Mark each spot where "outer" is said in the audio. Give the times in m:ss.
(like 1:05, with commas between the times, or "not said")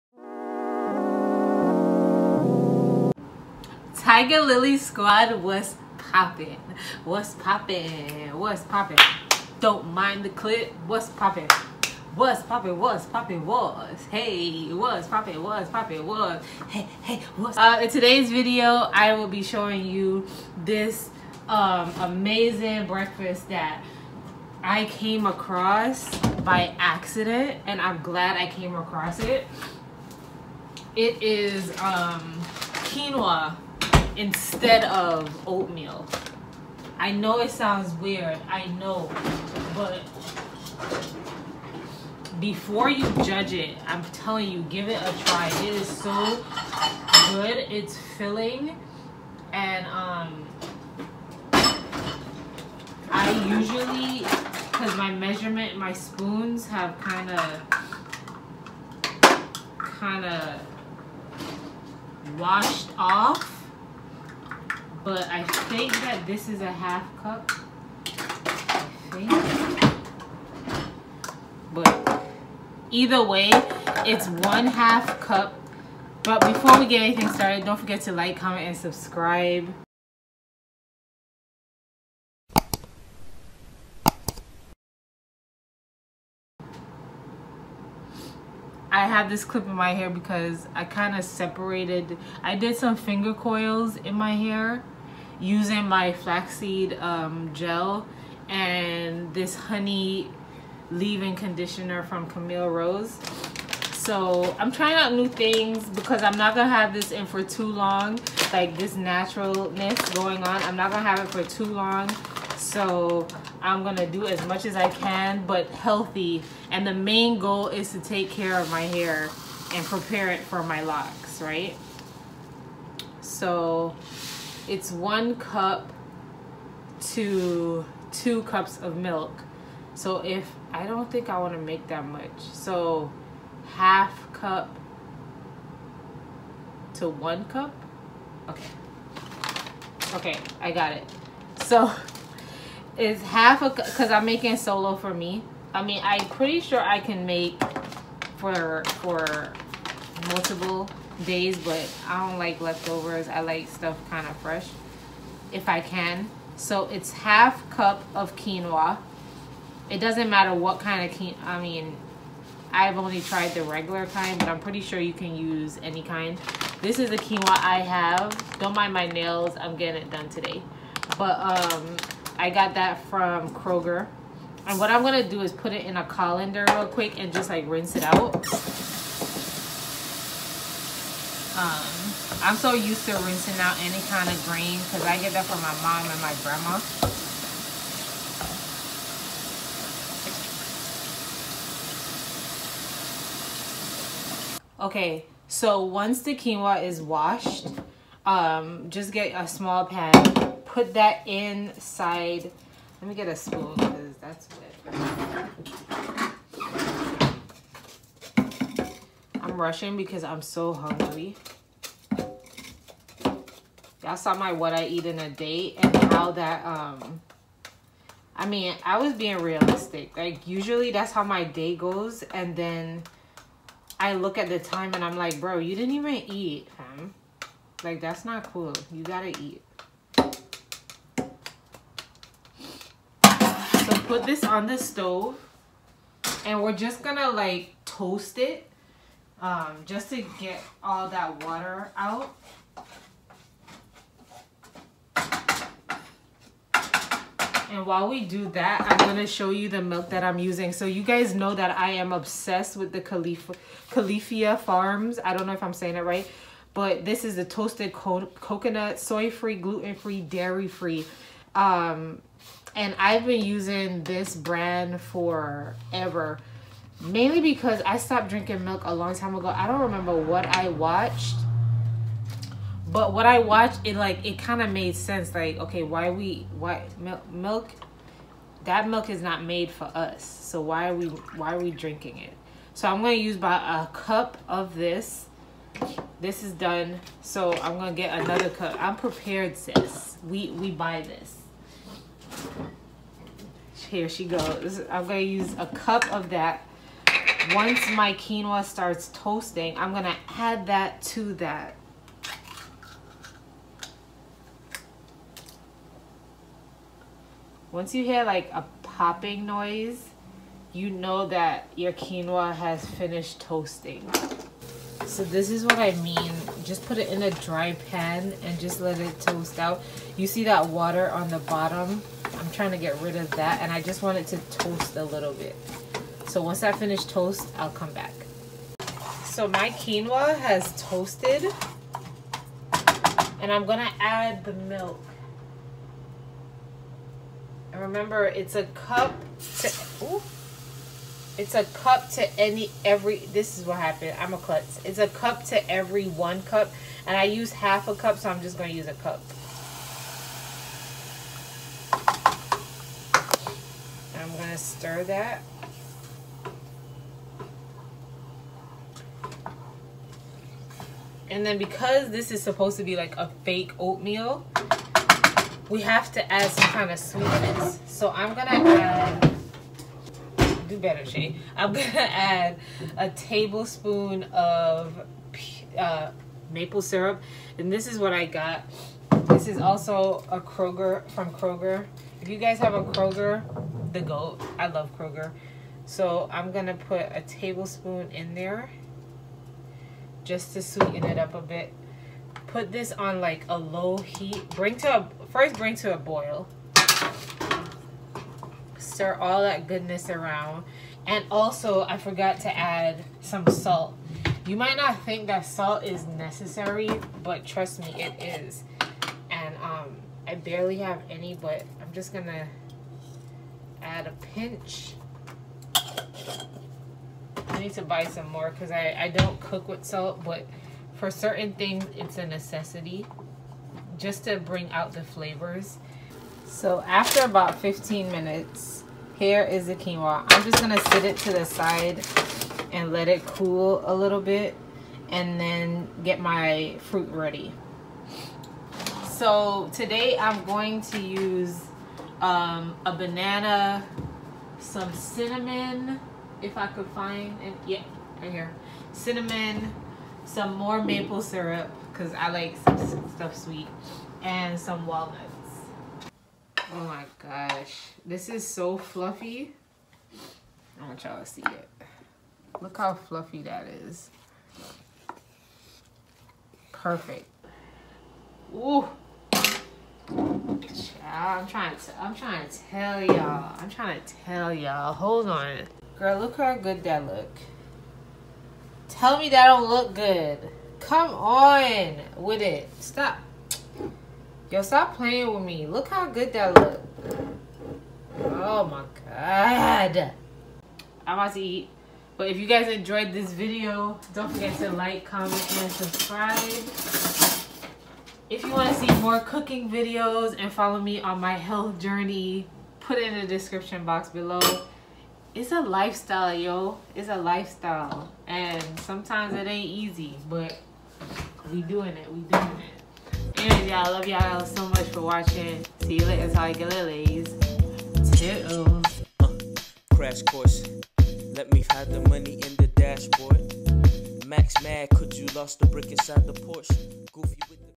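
not said.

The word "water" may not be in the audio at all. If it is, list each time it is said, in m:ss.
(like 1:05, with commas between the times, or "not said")
4:01, 5:20.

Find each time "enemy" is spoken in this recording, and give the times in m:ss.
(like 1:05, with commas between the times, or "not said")
not said.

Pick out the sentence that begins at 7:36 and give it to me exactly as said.
Oh my gosh, this is so fluffy.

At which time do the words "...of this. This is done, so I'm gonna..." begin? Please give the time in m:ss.
4:44.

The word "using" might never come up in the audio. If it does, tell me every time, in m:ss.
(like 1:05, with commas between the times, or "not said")
1:35, 4:10, 4:23.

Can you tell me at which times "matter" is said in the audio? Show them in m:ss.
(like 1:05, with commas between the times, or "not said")
2:40.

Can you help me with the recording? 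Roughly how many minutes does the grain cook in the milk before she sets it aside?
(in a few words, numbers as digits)
15.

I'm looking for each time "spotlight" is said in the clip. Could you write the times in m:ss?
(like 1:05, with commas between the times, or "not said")
not said.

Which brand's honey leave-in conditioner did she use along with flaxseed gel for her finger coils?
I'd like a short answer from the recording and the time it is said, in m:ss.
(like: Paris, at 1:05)
Camille Rose, at 1:42.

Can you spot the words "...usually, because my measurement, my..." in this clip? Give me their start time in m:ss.
0:53.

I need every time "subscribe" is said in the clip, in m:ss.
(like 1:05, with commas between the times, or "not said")
1:18, 8:15.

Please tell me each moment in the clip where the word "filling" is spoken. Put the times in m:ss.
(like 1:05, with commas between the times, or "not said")
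0:48.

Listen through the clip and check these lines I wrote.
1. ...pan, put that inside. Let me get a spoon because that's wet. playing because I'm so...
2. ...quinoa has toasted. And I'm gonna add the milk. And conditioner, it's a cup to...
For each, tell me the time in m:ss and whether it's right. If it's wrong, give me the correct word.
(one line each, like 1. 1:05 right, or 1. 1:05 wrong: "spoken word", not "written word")
1. 3:19 wrong: "rushing", not "playing"
2. 5:29 wrong: "remember", not "conditioner".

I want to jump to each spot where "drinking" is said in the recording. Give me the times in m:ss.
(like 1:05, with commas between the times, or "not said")
4:28, 4:41.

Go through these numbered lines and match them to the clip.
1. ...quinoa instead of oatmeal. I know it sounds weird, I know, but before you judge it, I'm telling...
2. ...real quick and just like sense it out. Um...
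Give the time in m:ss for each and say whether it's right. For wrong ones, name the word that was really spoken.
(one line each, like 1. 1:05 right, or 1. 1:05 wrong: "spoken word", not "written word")
1. 0:32 right
2. 2:56 wrong: "rinse", not "sense".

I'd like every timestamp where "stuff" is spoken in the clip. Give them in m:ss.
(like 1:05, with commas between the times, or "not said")
2:33, 7:33.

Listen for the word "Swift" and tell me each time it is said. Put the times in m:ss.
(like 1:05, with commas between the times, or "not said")
not said.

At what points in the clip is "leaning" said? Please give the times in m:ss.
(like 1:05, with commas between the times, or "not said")
not said.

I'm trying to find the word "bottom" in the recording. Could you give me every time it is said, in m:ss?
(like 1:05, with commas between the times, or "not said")
5:21.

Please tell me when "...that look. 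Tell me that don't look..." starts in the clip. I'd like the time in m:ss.
7:56.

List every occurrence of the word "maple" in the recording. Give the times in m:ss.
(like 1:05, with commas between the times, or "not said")
6:16, 7:30.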